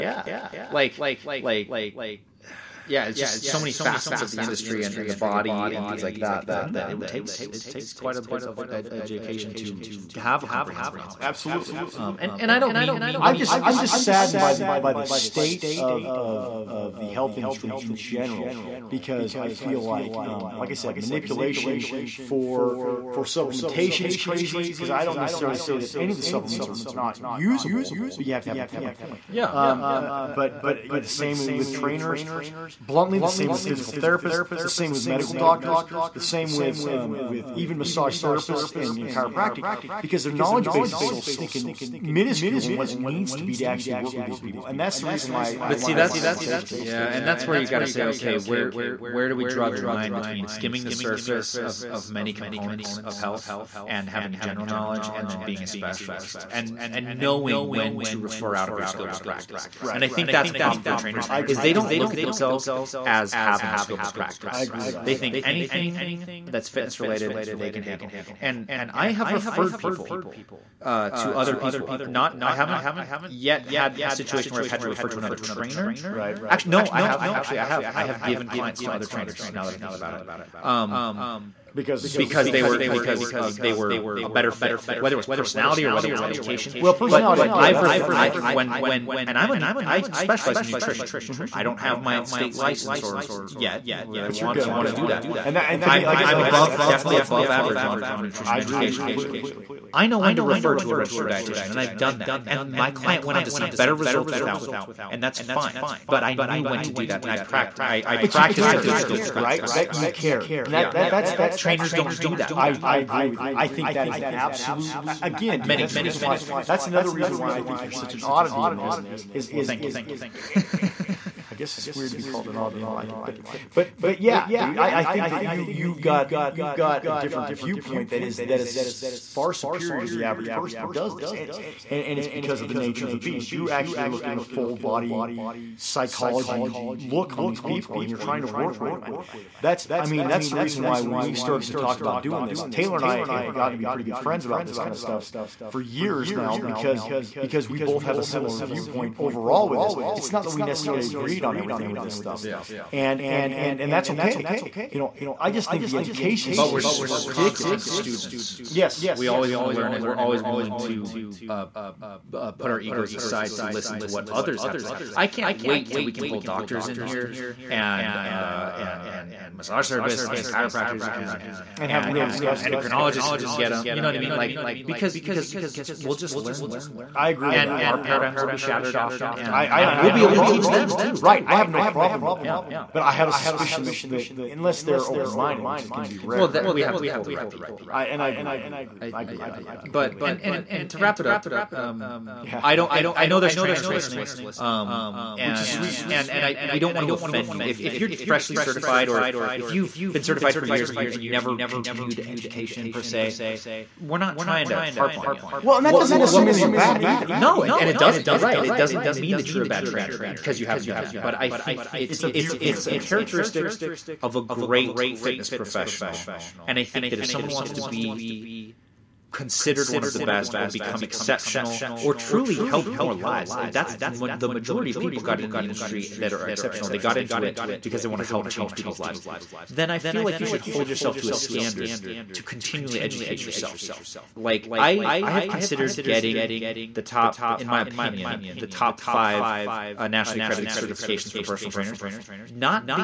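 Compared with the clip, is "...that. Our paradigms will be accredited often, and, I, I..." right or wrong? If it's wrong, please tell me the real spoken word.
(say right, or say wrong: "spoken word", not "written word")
wrong: "shattered", not "accredited".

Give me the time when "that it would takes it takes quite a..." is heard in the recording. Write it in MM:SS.
00:06.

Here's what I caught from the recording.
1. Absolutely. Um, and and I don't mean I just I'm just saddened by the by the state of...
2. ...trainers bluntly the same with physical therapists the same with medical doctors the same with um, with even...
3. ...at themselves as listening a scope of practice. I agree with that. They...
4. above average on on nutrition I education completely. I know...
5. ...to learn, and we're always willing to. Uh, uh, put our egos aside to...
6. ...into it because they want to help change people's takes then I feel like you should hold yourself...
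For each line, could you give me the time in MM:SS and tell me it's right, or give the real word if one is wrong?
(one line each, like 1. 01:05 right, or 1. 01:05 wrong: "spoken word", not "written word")
1. 00:11 right
2. 00:31 right
3. 01:02 wrong: "having", not "listening"
4. 01:37 right
5. 02:39 right
6. 03:47 wrong: "lives", not "takes".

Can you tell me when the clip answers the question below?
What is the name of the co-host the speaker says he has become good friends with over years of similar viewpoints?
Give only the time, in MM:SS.
02:22.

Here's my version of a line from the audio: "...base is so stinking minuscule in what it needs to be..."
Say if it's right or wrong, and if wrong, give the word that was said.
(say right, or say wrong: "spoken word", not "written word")
right.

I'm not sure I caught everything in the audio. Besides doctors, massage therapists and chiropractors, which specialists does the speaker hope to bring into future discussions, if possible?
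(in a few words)
Endocrinologists.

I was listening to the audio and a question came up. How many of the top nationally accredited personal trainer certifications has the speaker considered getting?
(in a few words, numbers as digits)
5.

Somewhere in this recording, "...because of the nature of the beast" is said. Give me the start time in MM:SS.
02:12.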